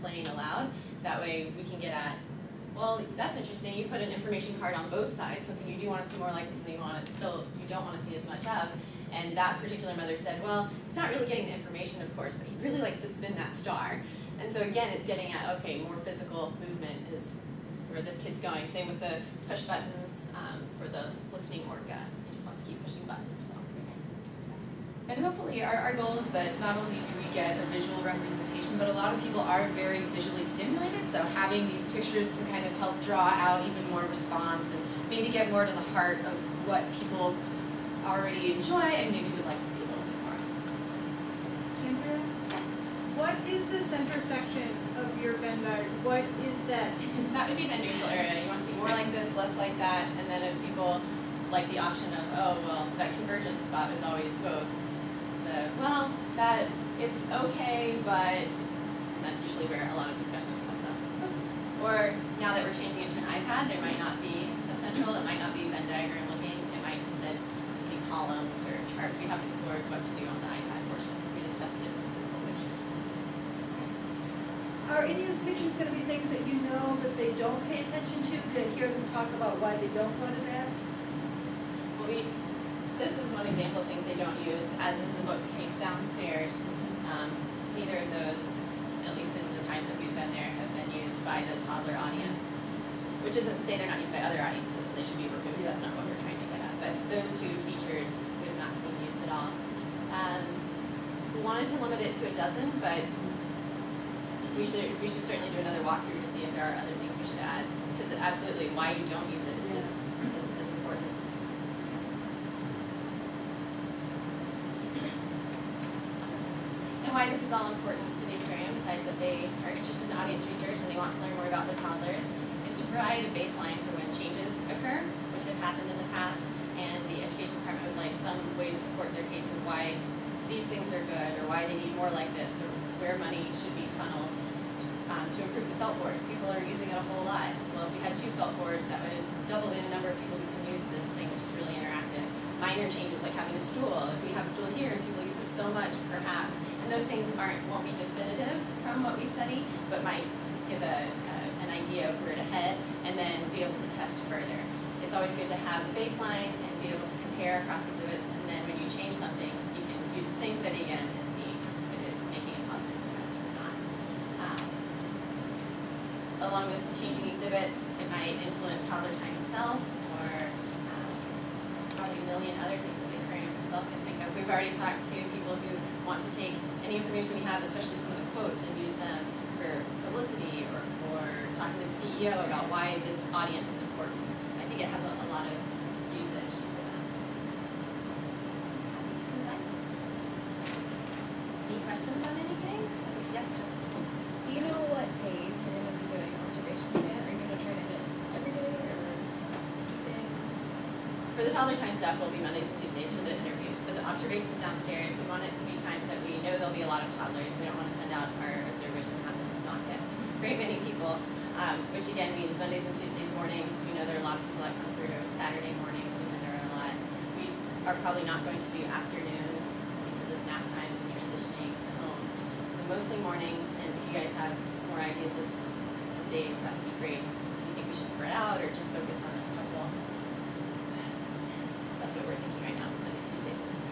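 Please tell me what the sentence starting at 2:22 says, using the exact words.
Minor changes like having a stool.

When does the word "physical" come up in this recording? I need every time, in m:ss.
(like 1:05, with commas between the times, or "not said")
0:15, 1:12.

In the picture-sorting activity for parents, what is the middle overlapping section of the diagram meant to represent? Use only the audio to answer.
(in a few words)
neutral area.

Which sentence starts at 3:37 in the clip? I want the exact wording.
We are probably not going to do afternoons because of nap times and transitioning to home.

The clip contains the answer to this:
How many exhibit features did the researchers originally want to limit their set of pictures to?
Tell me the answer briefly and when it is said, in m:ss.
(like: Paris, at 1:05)
12, at 1:42.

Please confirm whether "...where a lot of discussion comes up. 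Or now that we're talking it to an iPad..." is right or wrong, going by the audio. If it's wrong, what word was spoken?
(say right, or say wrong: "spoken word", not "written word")
wrong: "changing", not "talking".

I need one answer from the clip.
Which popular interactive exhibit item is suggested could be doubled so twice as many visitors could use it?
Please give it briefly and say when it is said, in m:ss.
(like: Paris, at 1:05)
felt board, at 2:18.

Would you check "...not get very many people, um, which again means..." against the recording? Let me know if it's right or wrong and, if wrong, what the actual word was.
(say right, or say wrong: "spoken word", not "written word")
right.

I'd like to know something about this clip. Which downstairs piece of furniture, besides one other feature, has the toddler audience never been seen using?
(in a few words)
bookcase.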